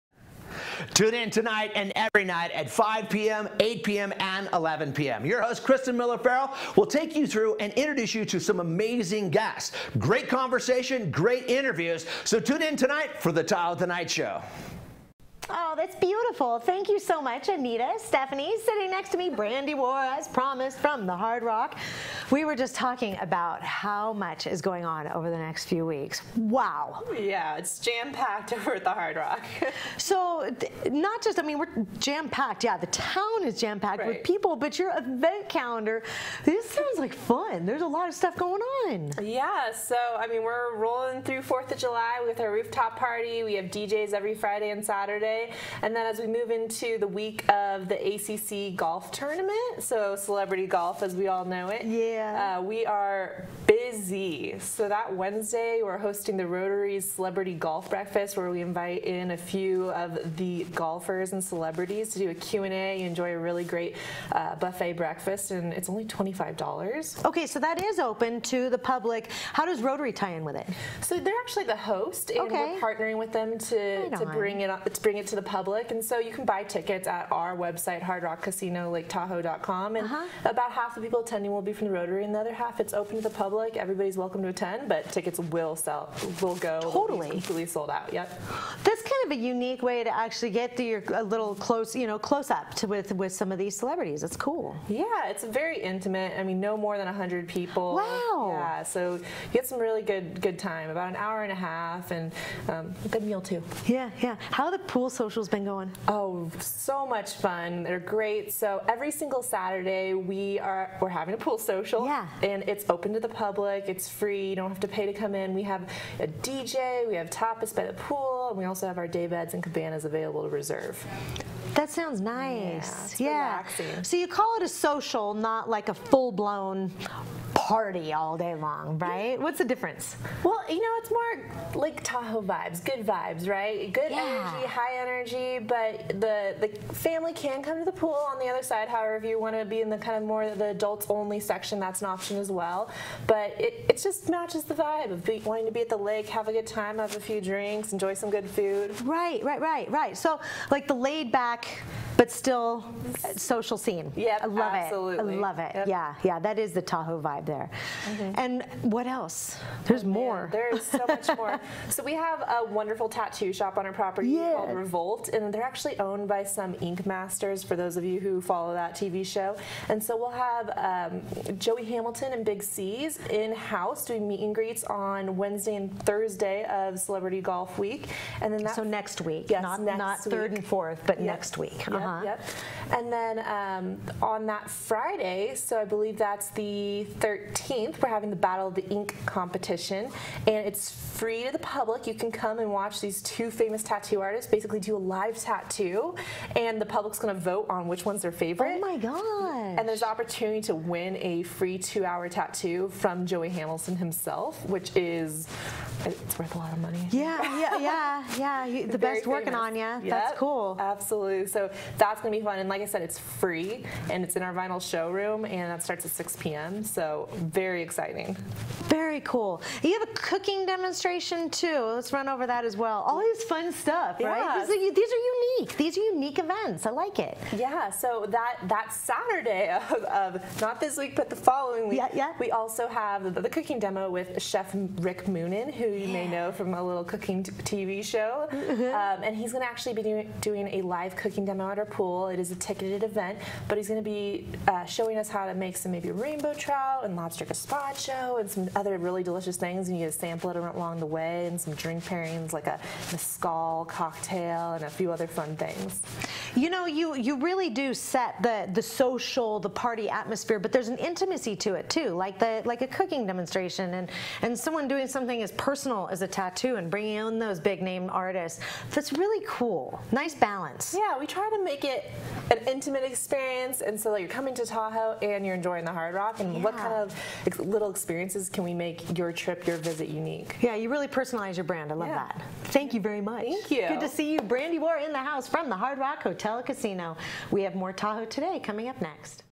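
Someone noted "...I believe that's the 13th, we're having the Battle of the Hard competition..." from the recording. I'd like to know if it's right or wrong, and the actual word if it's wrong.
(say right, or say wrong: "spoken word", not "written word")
wrong: "Ink", not "Hard".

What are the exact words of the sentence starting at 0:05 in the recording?
Your host, Kristen Miller Farrell, will take you through and introduce you to some amazing guests.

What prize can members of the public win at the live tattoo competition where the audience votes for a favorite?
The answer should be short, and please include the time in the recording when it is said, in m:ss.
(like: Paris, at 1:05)
Free two-hour tattoo, at 3:21.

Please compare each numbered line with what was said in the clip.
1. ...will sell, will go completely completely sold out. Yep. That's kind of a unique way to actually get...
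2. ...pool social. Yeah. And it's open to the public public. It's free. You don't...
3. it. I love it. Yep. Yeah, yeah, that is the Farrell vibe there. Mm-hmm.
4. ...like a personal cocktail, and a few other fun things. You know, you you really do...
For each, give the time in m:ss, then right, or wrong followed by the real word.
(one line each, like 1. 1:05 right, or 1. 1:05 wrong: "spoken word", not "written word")
1. 1:25 wrong: "totally", not "completely"
2. 1:51 right
3. 2:35 wrong: "Tahoe", not "Farrell"
4. 4:12 wrong: "mezcal", not "personal".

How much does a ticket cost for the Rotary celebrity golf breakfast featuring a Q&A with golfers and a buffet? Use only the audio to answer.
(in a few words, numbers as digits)
$25.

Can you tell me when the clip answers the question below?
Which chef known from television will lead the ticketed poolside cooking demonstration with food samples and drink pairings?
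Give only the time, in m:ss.
3:54.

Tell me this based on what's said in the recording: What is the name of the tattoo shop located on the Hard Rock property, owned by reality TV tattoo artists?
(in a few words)
Revolt.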